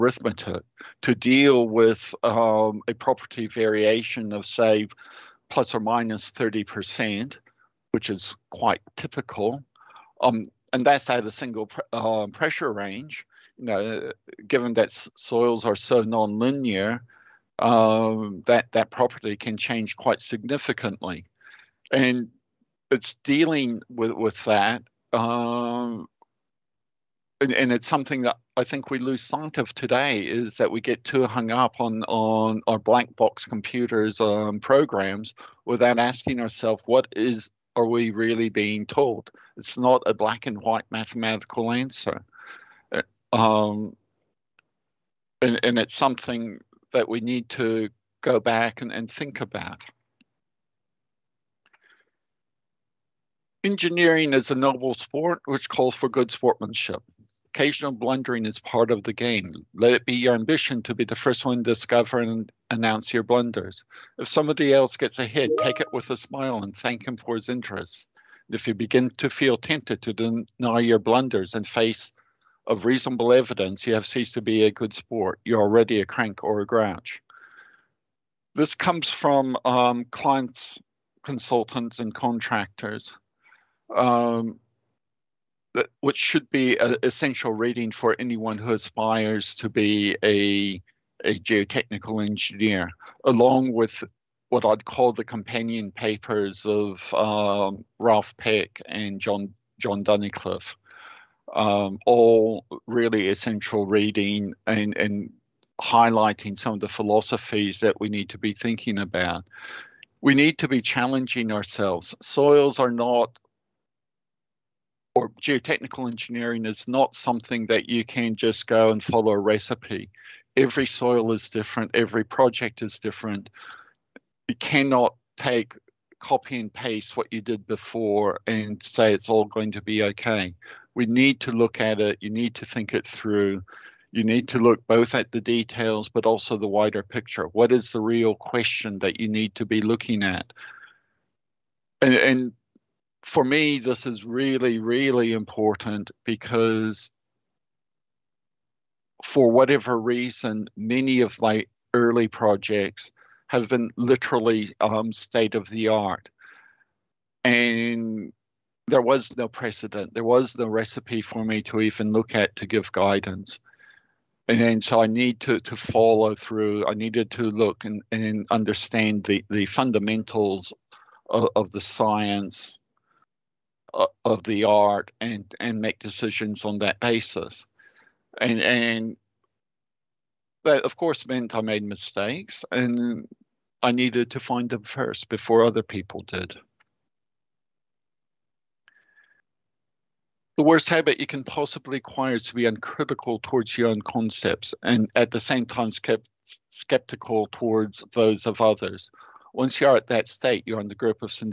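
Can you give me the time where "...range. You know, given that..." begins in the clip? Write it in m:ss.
0:12.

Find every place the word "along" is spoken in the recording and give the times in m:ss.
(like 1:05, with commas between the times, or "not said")
1:33.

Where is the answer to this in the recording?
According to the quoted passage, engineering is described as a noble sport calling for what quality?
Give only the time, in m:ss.
0:56.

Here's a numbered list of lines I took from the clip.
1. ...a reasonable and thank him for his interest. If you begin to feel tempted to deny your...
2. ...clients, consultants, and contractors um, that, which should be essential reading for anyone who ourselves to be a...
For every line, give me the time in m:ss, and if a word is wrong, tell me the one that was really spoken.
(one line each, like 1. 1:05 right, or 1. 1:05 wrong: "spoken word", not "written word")
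1. 1:06 wrong: "smile", not "reasonable"
2. 1:20 wrong: "aspires", not "ourselves".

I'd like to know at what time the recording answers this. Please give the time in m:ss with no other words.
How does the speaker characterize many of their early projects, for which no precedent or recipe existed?
2:35.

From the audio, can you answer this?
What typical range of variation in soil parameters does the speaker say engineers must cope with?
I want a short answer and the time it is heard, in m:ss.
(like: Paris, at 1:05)
plus or minus 30%, at 0:05.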